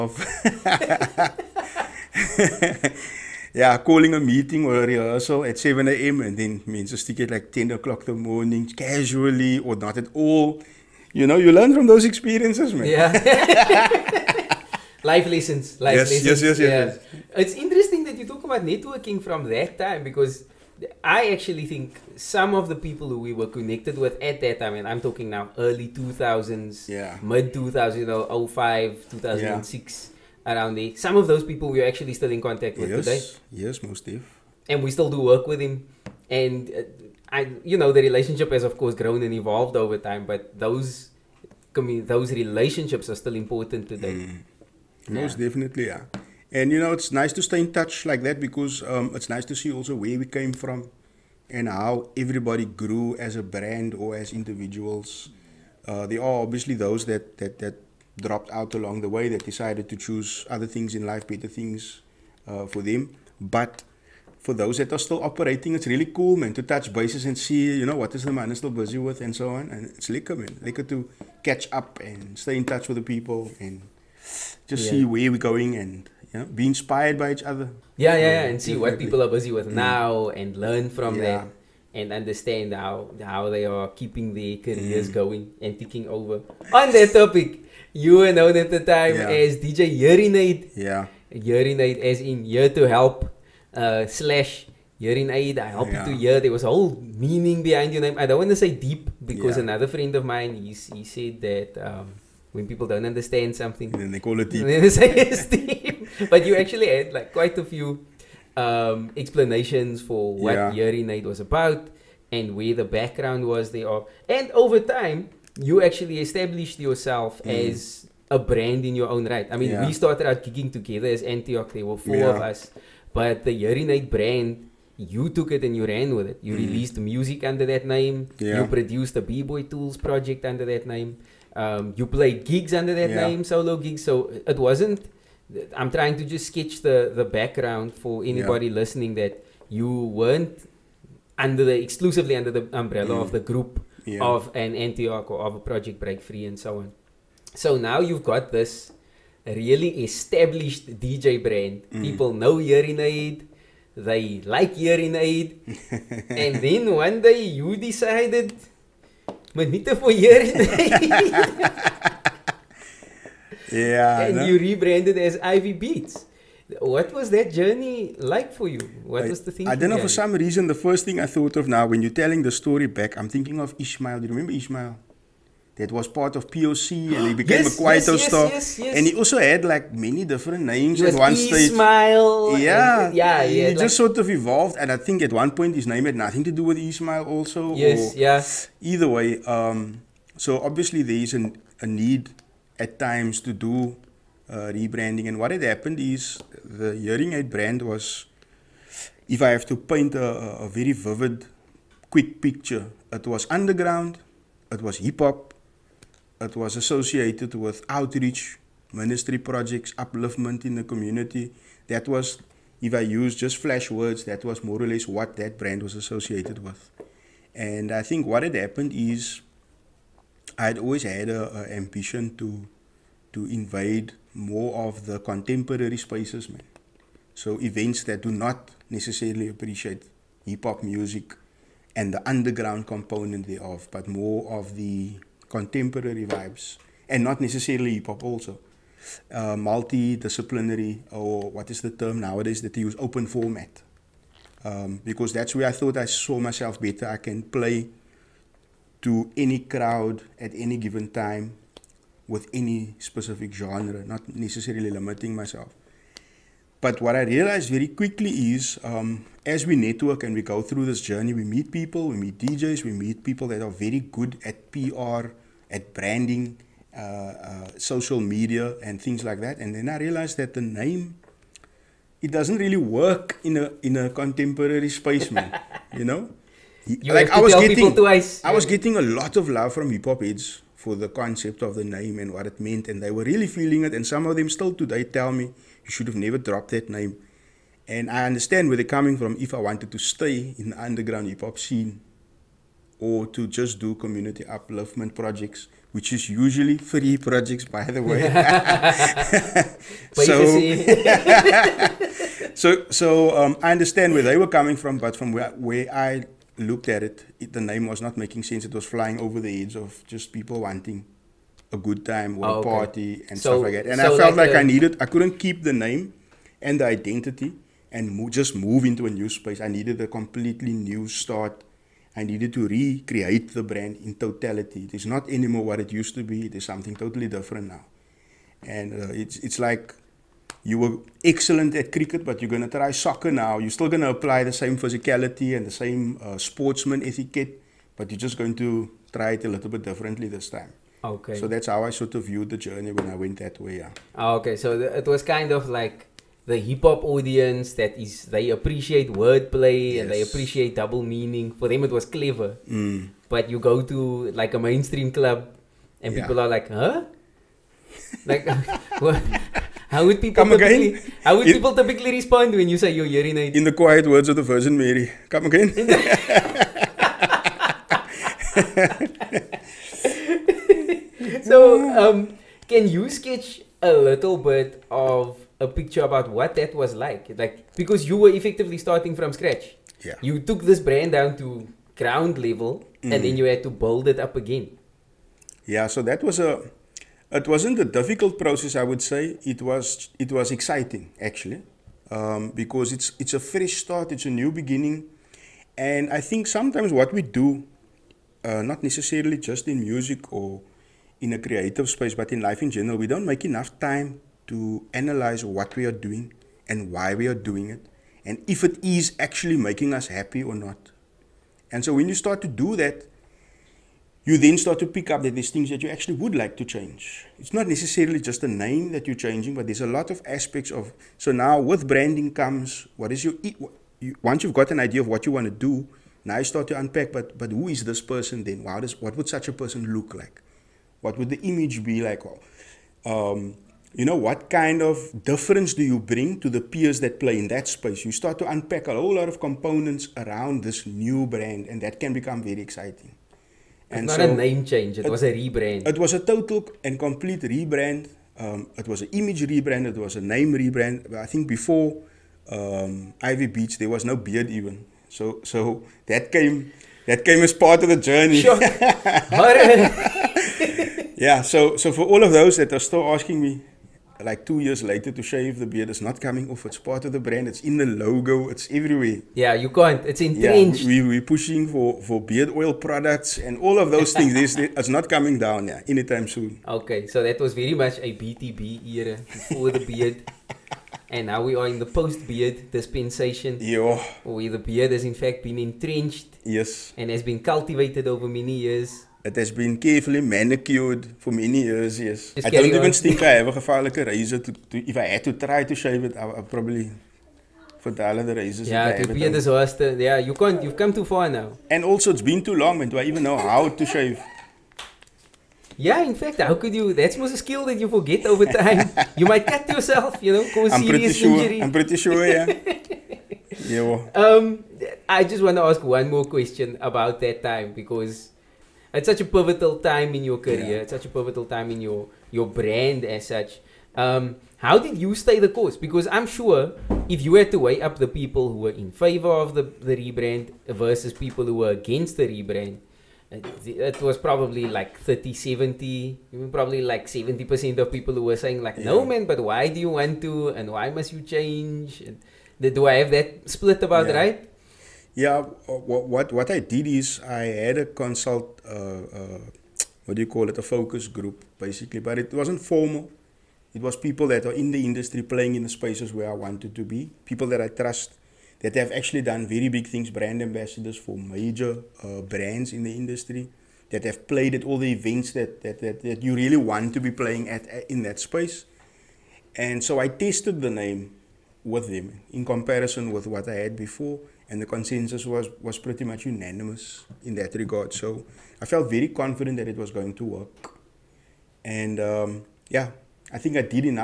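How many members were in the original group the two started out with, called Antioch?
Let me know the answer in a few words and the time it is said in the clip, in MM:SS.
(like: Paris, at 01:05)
4, at 02:01.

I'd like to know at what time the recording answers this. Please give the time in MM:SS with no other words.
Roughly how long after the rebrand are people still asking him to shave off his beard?
07:44.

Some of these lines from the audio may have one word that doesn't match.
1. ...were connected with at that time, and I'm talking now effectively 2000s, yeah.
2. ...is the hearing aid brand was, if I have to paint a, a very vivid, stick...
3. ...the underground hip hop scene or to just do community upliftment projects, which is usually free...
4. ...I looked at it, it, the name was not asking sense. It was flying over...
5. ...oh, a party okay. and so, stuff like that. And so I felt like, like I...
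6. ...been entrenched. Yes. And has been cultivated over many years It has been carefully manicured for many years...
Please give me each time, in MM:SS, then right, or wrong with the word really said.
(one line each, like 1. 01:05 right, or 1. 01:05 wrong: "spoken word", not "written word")
1. 00:23 wrong: "early", not "effectively"
2. 03:15 wrong: "quick", not "stick"
3. 04:50 right
4. 05:05 wrong: "making", not "asking"
5. 05:12 right
6. 08:05 right.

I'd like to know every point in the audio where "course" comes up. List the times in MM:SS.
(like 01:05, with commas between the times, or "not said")
00:38, 08:45.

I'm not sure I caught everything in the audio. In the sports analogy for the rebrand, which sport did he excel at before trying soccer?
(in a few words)
Cricket.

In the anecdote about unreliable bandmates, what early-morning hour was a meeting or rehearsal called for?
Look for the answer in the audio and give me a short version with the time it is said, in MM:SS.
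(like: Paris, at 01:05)
7 a.m., at 00:05.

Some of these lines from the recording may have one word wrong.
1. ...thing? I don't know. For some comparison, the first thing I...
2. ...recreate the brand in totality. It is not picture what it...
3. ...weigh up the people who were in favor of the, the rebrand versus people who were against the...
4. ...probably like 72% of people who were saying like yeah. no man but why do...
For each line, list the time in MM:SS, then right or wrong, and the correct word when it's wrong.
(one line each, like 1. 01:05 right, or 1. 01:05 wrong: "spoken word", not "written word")
1. 02:49 wrong: "reason", not "comparison"
2. 05:22 wrong: "anymore", not "picture"
3. 08:47 right
4. 08:56 wrong: "70", not "72".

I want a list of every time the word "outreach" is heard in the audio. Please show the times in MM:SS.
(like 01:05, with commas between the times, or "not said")
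03:27.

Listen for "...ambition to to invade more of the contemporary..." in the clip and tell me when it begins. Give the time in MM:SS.
03:41.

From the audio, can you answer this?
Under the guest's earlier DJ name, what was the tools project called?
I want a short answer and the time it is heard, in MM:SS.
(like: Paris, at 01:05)
B Boy Tools, at 02:09.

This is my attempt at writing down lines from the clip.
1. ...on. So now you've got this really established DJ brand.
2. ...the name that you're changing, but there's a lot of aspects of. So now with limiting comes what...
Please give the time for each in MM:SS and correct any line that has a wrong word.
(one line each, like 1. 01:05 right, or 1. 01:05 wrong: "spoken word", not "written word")
1. 02:26 right
2. 06:58 wrong: "branding", not "limiting".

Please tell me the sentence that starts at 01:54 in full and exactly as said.
And over time, you actually established yourself mm.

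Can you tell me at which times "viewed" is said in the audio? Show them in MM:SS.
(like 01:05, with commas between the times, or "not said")
05:42.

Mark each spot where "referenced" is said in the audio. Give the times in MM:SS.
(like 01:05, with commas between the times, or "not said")
not said.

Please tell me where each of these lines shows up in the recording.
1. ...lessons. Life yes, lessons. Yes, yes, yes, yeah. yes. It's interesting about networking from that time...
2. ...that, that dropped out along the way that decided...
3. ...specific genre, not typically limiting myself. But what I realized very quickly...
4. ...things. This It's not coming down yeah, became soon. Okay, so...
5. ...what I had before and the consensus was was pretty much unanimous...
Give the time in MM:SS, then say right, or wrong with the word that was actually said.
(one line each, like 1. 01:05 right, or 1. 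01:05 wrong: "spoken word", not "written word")
1. 00:15 right
2. 00:57 right
3. 04:12 wrong: "necessarily", not "typically"
4. 07:54 wrong: "anytime", not "became"
5. 09:33 right.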